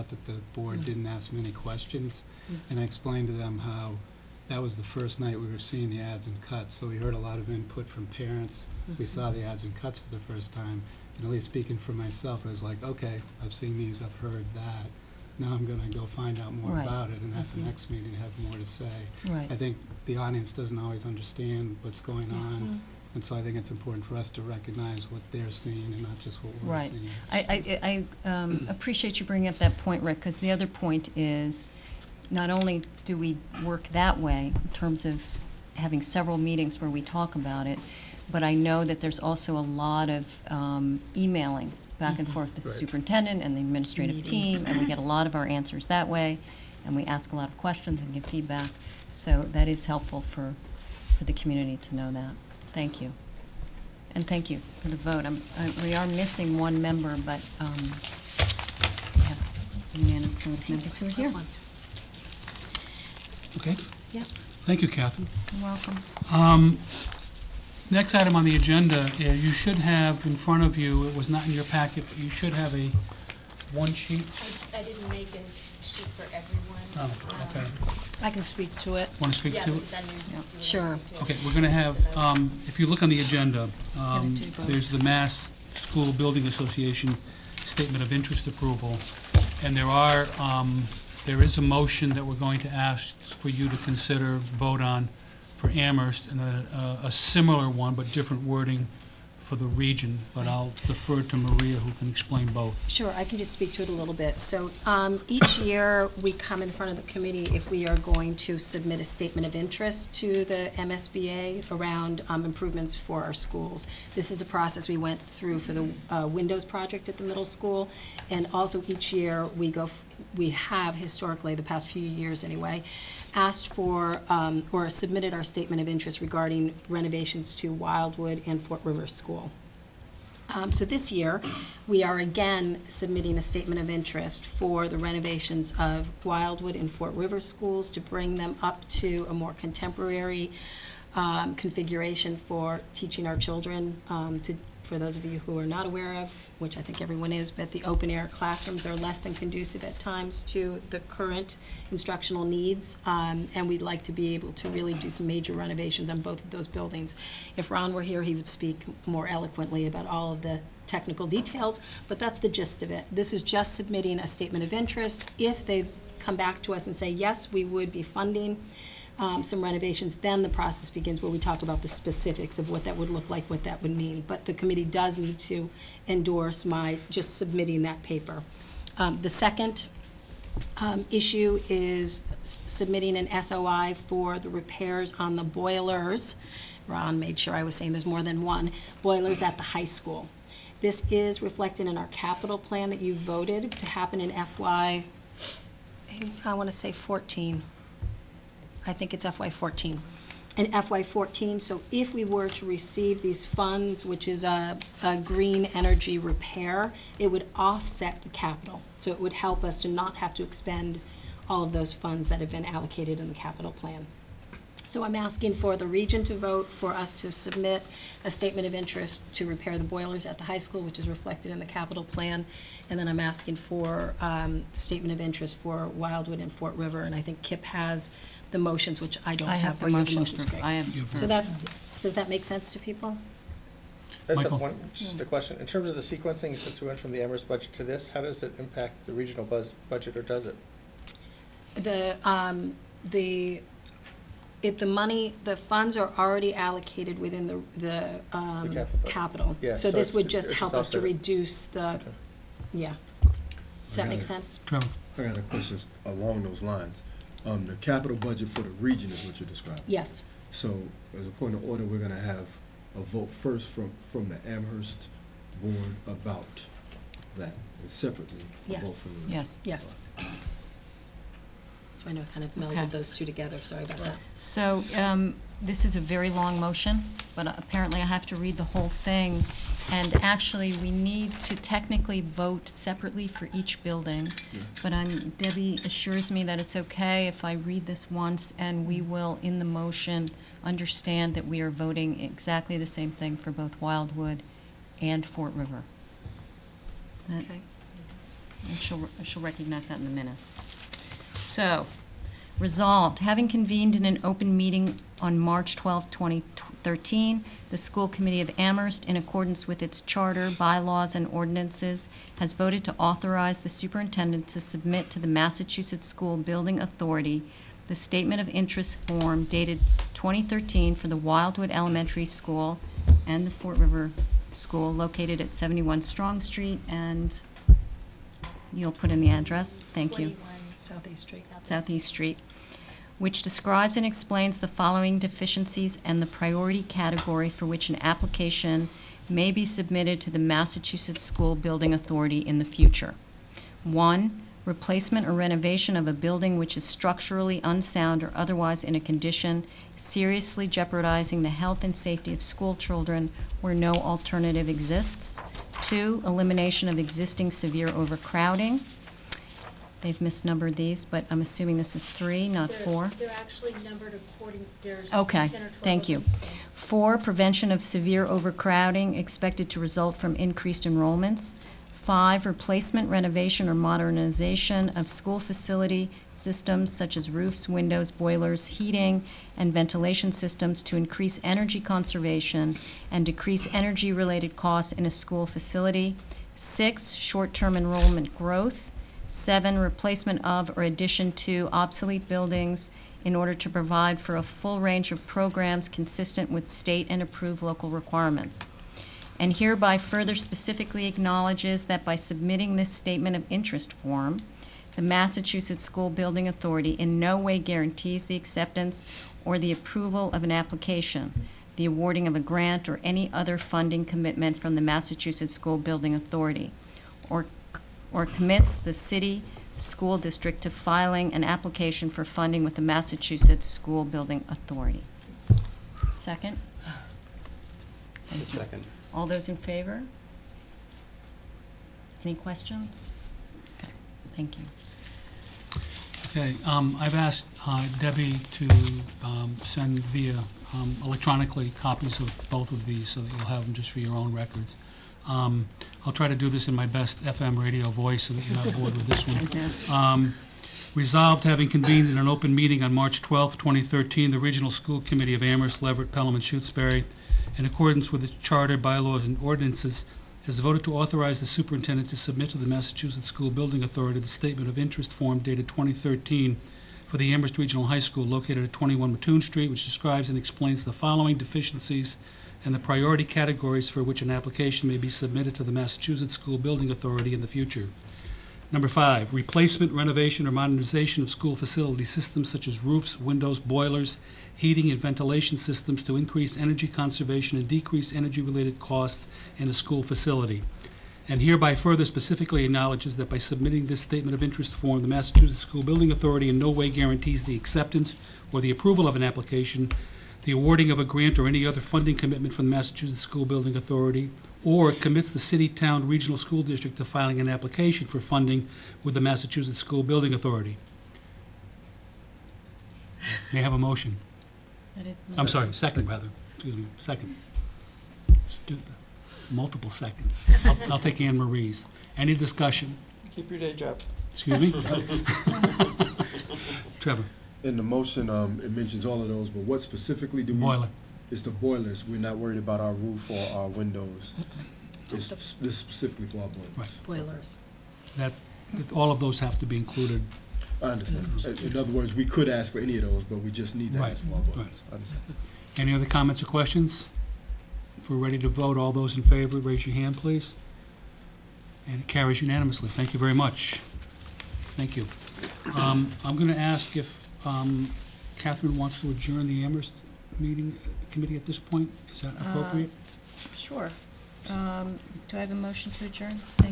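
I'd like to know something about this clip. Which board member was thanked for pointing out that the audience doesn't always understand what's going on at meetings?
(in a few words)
Rick.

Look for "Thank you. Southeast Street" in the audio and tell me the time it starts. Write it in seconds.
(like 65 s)
329 s.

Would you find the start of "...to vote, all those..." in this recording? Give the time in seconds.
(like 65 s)
548 s.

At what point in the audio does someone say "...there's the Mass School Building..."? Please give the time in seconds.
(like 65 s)
84 s.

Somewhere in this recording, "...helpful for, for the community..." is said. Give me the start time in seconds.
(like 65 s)
49 s.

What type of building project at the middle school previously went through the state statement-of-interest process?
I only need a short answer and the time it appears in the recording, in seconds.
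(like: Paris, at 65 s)
Windows project, at 116 s.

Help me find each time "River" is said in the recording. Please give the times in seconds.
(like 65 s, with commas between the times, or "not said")
128 s, 137 s, 226 s, 295 s, 323 s.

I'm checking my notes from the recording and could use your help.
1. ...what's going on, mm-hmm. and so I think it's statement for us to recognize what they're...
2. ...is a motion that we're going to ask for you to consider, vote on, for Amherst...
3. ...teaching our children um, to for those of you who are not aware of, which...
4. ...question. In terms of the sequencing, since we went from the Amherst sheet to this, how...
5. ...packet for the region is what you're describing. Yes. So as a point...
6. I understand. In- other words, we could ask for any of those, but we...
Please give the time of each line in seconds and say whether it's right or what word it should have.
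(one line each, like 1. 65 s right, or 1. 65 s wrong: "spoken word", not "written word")
1. 21 s wrong: "important", not "statement"
2. 91 s right
3. 142 s right
4. 235 s wrong: "budget", not "sheet"
5. 258 s wrong: "budget", not "packet"
6. 540 s right.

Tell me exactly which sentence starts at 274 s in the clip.
So um, this is a very long motion, but apparently I have to read the whole thing.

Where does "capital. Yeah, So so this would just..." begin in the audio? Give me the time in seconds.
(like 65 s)
249 s.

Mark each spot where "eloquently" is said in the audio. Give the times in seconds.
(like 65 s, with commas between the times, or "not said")
159 s.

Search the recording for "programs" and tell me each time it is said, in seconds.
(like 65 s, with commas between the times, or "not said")
395 s.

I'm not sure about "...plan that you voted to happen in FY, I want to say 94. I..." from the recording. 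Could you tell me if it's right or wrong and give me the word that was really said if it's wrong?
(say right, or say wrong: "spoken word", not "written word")
wrong: "14", not "94".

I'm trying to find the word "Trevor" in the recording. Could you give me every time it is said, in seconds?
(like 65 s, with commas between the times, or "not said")
254 s, 527 s.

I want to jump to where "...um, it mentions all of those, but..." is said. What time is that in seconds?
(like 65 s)
528 s.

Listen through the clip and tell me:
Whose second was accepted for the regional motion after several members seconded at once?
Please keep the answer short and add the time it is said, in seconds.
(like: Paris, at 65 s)
Anne Marie, at 521 s.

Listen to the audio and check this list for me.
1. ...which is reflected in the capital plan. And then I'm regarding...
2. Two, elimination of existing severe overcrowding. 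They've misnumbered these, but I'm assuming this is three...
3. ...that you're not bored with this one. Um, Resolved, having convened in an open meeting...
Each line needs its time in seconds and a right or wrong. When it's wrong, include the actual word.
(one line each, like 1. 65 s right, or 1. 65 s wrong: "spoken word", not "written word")
1. 220 s wrong: "asking", not "regarding"
2. 355 s right
3. 448 s right.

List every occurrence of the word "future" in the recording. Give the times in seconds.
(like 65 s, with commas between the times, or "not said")
342 s, 477 s.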